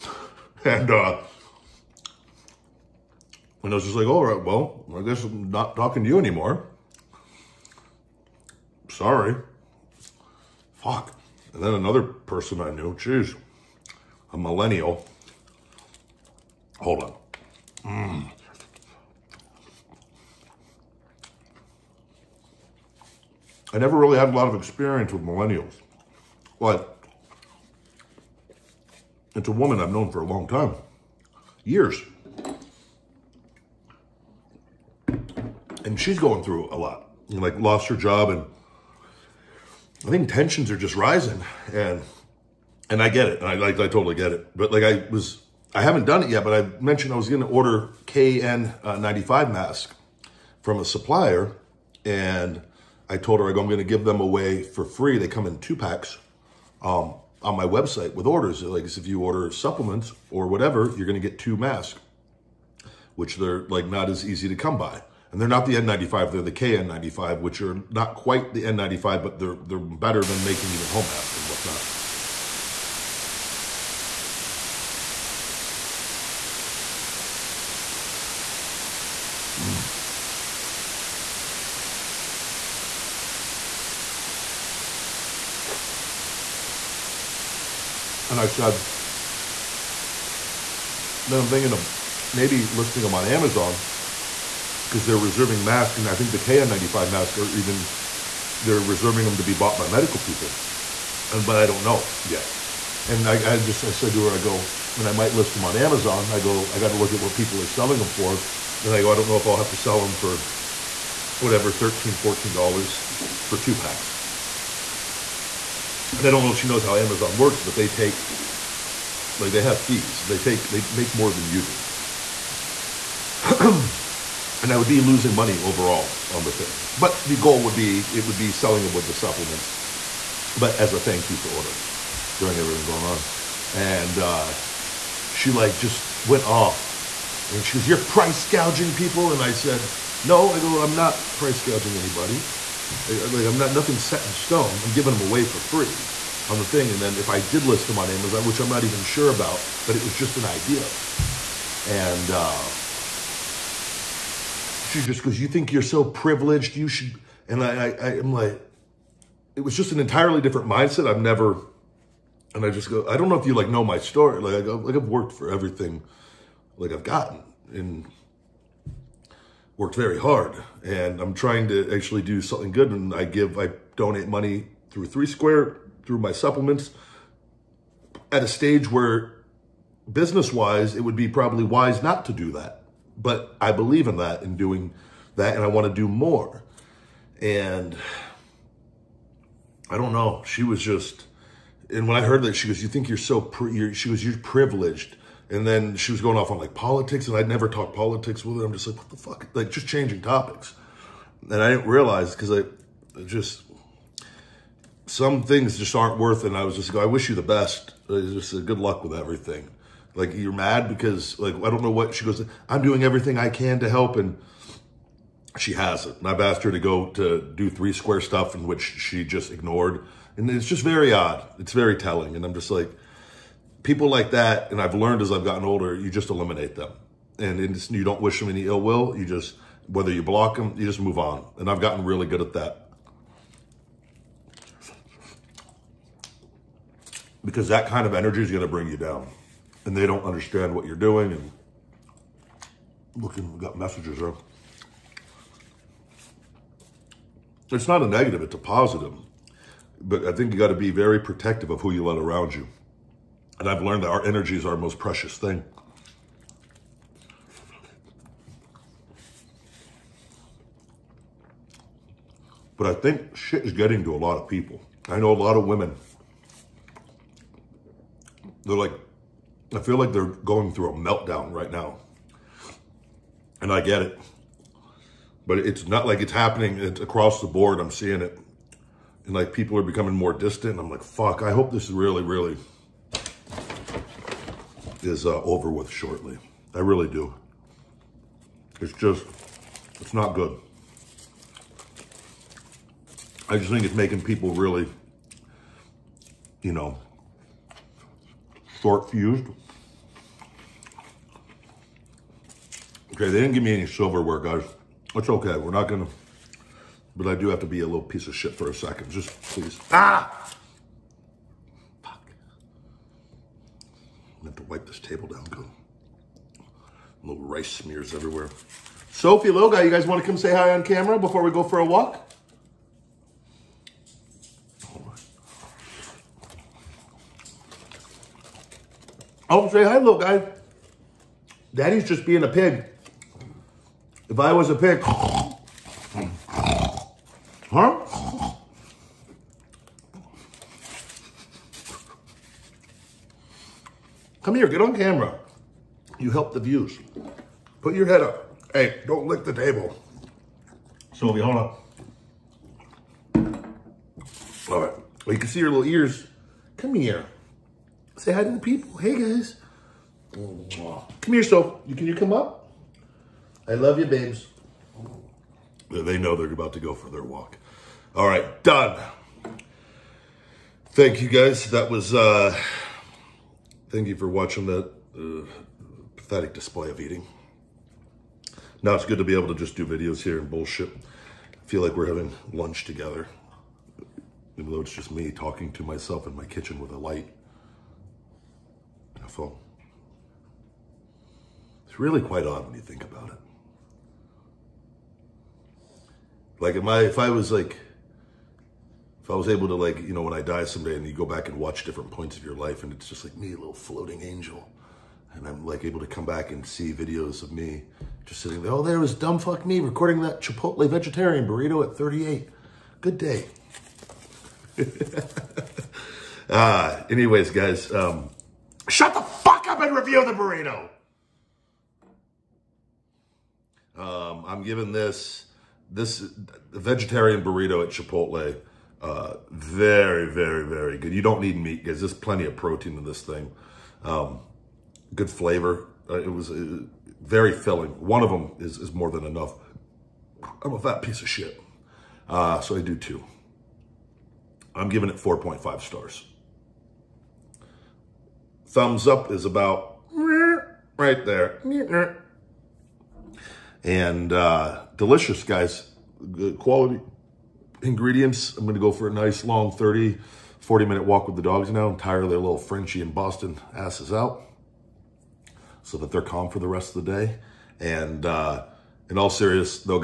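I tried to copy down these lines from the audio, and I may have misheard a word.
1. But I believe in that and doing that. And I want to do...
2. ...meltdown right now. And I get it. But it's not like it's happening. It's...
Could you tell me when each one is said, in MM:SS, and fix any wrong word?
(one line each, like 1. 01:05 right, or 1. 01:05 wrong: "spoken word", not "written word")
1. 03:03 right
2. 04:30 right.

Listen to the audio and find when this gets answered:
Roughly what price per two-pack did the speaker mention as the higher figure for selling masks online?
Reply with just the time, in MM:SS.
01:52.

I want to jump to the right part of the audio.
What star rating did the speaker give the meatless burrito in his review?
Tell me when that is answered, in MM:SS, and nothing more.
07:25.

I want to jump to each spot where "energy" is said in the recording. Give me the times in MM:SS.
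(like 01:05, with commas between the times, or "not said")
03:58, 04:14.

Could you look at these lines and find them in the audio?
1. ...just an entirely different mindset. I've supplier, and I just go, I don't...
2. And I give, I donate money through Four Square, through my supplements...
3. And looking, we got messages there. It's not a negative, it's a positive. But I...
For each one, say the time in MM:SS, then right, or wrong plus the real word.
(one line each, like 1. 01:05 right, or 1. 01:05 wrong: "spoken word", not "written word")
1. 02:39 wrong: "never", not "supplier"
2. 02:52 wrong: "Three", not "Four"
3. 04:01 right.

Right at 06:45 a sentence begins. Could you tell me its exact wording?
And I'm like able to come back and see videos of me just sitting there.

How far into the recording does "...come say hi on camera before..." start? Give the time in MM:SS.
05:20.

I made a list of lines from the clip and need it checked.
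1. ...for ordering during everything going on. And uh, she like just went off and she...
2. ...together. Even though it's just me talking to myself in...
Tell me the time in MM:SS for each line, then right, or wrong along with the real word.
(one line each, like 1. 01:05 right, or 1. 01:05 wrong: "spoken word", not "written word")
1. 02:11 right
2. 06:22 right.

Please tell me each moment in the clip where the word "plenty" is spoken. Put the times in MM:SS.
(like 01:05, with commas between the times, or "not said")
07:12.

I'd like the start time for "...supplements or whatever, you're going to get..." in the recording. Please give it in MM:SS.
00:59.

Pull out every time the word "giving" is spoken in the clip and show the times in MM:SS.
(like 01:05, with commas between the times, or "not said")
02:24, 07:04, 07:24.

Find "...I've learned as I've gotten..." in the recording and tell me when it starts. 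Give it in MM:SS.
03:44.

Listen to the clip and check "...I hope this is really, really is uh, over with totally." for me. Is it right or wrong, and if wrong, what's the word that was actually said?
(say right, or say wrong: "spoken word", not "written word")
wrong: "shortly", not "totally".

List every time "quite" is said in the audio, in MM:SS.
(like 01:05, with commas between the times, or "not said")
01:08, 06:32.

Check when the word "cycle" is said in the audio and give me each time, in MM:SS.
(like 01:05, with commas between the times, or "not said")
not said.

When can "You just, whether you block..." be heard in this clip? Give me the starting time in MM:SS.
03:49.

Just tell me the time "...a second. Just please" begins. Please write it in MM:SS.
05:08.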